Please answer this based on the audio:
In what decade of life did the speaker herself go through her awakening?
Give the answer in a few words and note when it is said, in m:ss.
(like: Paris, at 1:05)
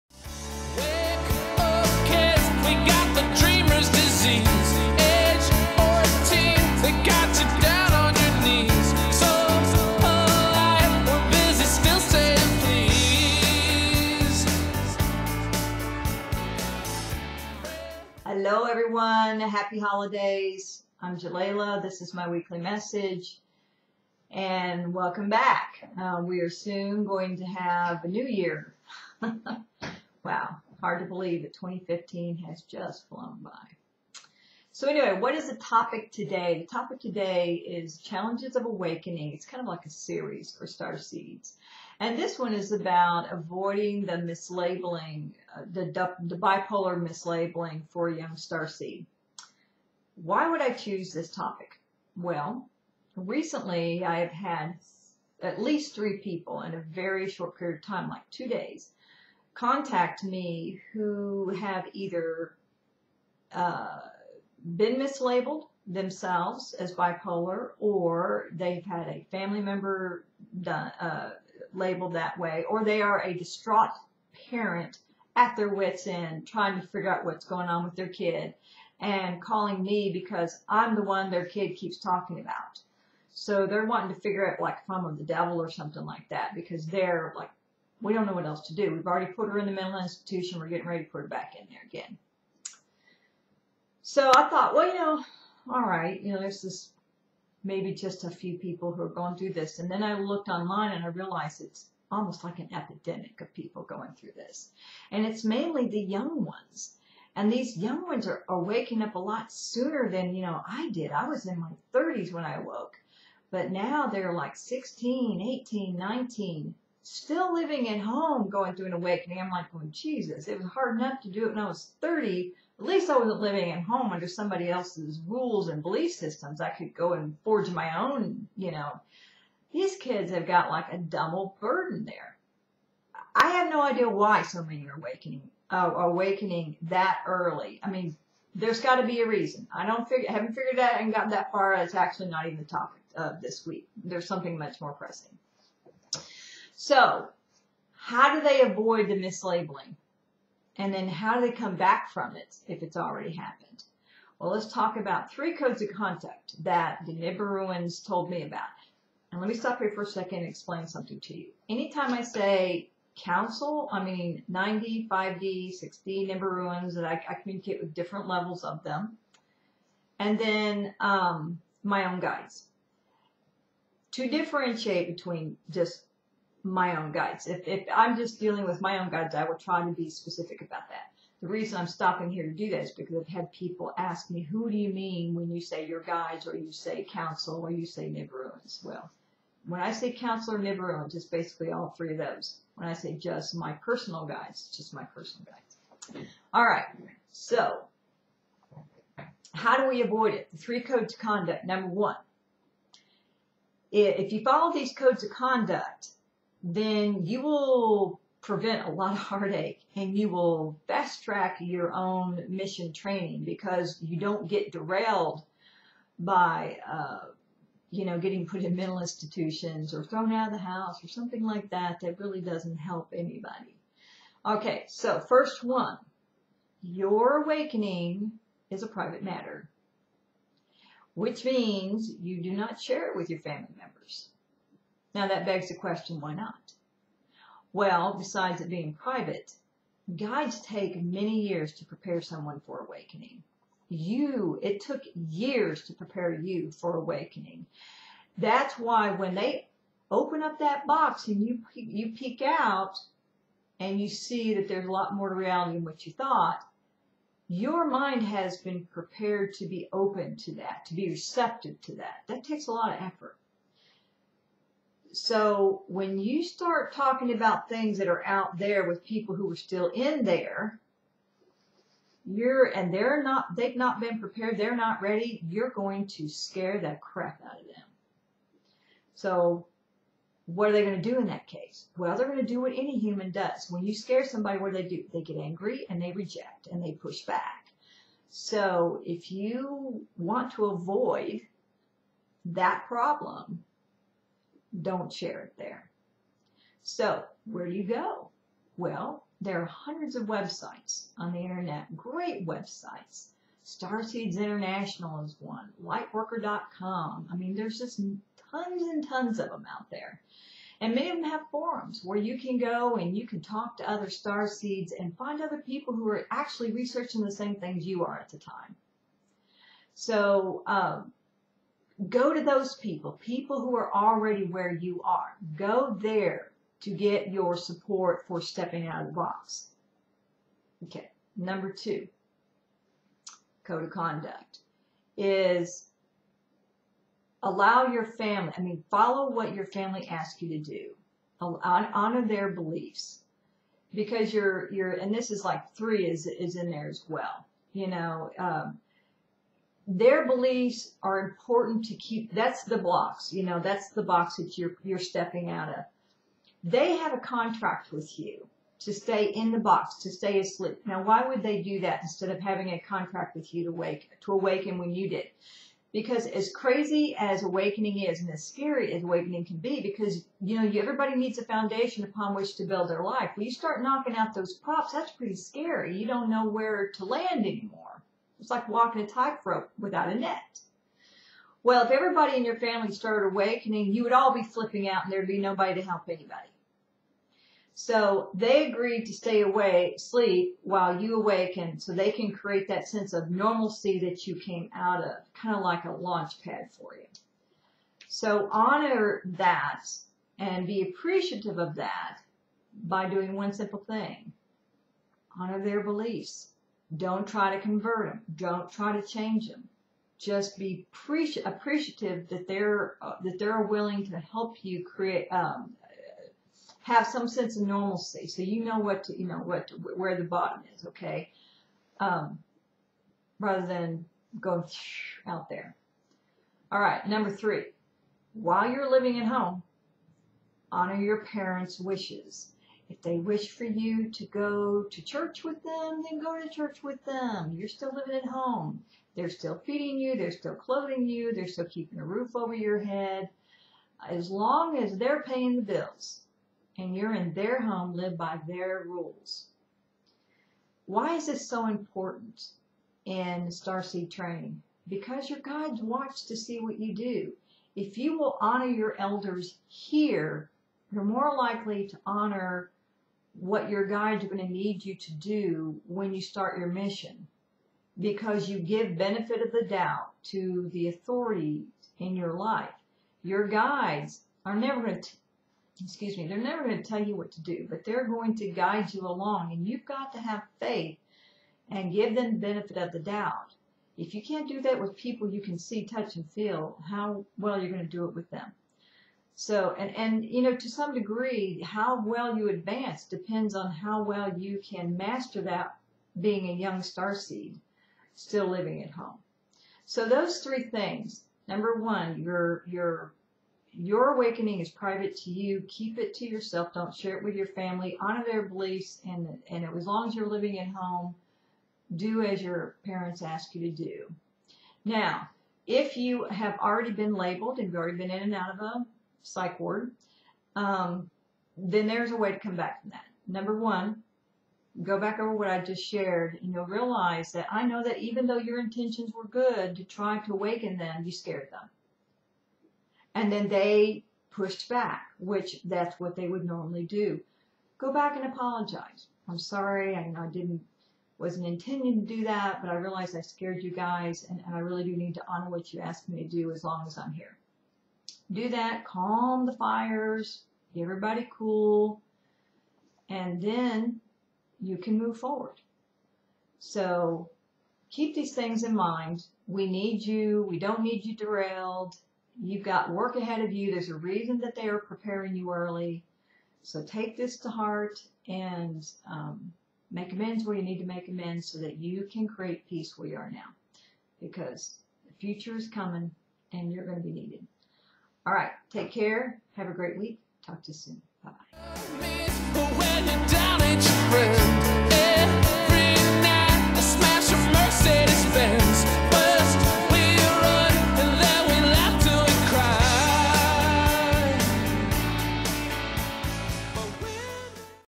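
her 30s, at 1:51.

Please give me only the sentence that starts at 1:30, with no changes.
We're getting ready to put her back in there again.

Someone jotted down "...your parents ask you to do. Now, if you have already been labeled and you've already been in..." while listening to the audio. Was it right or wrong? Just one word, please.
right.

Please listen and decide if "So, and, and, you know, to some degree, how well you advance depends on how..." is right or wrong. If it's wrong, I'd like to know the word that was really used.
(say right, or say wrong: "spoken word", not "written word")
right.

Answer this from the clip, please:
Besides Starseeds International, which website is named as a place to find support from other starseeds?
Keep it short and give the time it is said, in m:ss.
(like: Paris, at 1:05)
lightworker.com, at 5:05.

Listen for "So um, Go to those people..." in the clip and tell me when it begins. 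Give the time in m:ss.
5:19.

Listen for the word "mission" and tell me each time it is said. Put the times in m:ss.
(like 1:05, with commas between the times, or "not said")
3:32, 7:46.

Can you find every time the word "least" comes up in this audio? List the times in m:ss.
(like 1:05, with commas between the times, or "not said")
0:55, 2:02.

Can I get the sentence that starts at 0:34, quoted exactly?
So anyway, what is the topic today?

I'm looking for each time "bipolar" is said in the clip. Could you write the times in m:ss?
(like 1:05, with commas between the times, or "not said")
0:46, 1:06.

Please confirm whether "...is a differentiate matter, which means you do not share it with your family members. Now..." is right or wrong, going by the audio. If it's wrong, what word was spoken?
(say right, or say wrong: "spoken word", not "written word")
wrong: "private", not "differentiate".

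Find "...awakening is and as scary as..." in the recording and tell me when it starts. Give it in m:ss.
6:07.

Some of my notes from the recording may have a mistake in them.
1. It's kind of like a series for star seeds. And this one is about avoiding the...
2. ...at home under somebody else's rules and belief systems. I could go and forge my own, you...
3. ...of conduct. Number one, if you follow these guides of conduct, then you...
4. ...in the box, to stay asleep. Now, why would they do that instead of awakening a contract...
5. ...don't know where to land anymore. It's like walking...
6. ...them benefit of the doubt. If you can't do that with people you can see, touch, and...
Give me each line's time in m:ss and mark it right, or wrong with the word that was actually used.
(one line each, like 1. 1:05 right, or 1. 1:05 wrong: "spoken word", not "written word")
1. 0:39 right
2. 2:03 right
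3. 3:21 wrong: "codes", not "guides"
4. 5:59 wrong: "having", not "awakening"
5. 6:16 right
6. 8:02 right.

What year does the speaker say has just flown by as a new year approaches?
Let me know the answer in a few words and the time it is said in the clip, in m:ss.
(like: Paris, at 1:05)
2015, at 0:31.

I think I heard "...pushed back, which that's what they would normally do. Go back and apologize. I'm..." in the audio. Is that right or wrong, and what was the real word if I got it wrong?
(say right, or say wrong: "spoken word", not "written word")
right.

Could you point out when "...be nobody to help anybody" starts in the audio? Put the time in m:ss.
6:25.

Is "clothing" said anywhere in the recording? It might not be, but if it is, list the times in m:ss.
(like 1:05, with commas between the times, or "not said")
7:20.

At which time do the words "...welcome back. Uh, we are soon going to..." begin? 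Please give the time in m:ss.
0:24.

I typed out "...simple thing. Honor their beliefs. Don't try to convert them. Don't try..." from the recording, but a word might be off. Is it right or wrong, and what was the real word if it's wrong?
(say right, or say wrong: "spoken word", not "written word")
right.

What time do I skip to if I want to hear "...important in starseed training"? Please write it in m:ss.
7:31.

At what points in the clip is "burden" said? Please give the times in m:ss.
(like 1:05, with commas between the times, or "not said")
2:11.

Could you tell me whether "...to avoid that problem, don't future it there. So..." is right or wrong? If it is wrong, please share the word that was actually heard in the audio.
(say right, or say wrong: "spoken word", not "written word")
wrong: "share", not "future".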